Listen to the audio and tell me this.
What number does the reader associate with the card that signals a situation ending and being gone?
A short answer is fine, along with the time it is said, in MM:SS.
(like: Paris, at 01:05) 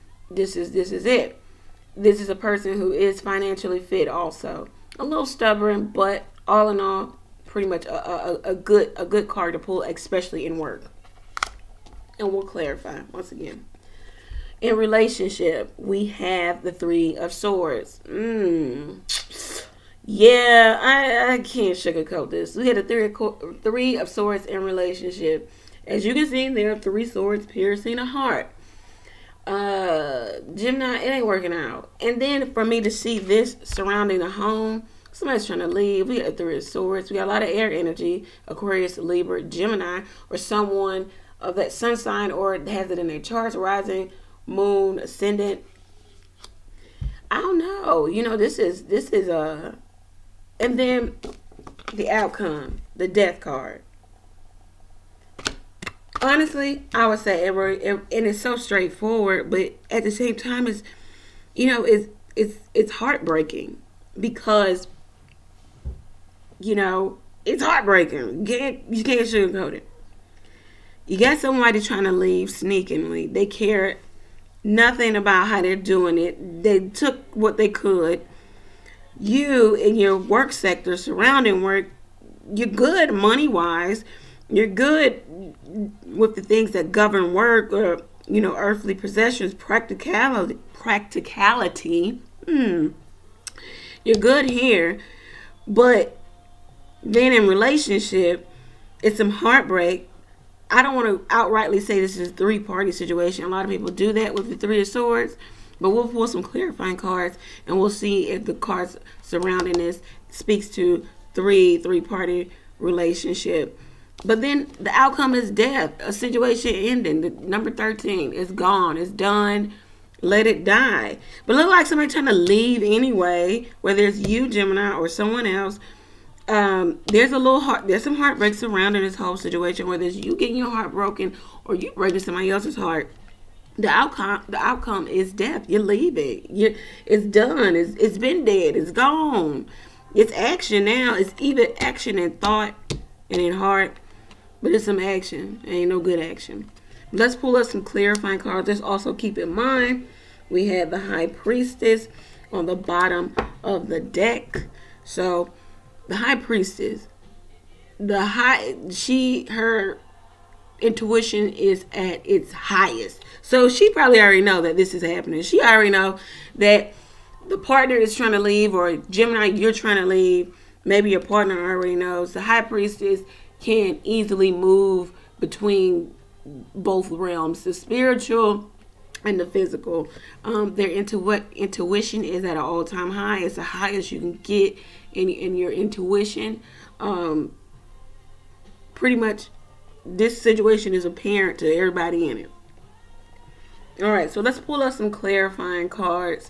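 13, at 01:57.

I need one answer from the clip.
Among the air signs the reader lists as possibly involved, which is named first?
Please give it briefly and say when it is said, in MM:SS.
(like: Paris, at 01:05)
Aquarius, at 00:38.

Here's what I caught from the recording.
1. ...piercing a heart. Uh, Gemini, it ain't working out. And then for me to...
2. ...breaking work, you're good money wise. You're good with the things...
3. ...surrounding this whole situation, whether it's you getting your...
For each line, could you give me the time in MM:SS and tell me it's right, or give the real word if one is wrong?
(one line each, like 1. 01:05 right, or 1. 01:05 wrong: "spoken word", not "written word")
1. 00:27 right
2. 01:20 wrong: "surrounding", not "breaking"
3. 02:08 right.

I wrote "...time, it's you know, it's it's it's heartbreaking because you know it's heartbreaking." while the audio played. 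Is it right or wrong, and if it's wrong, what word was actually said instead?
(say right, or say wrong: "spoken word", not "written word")
right.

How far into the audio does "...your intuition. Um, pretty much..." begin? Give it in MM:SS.
03:05.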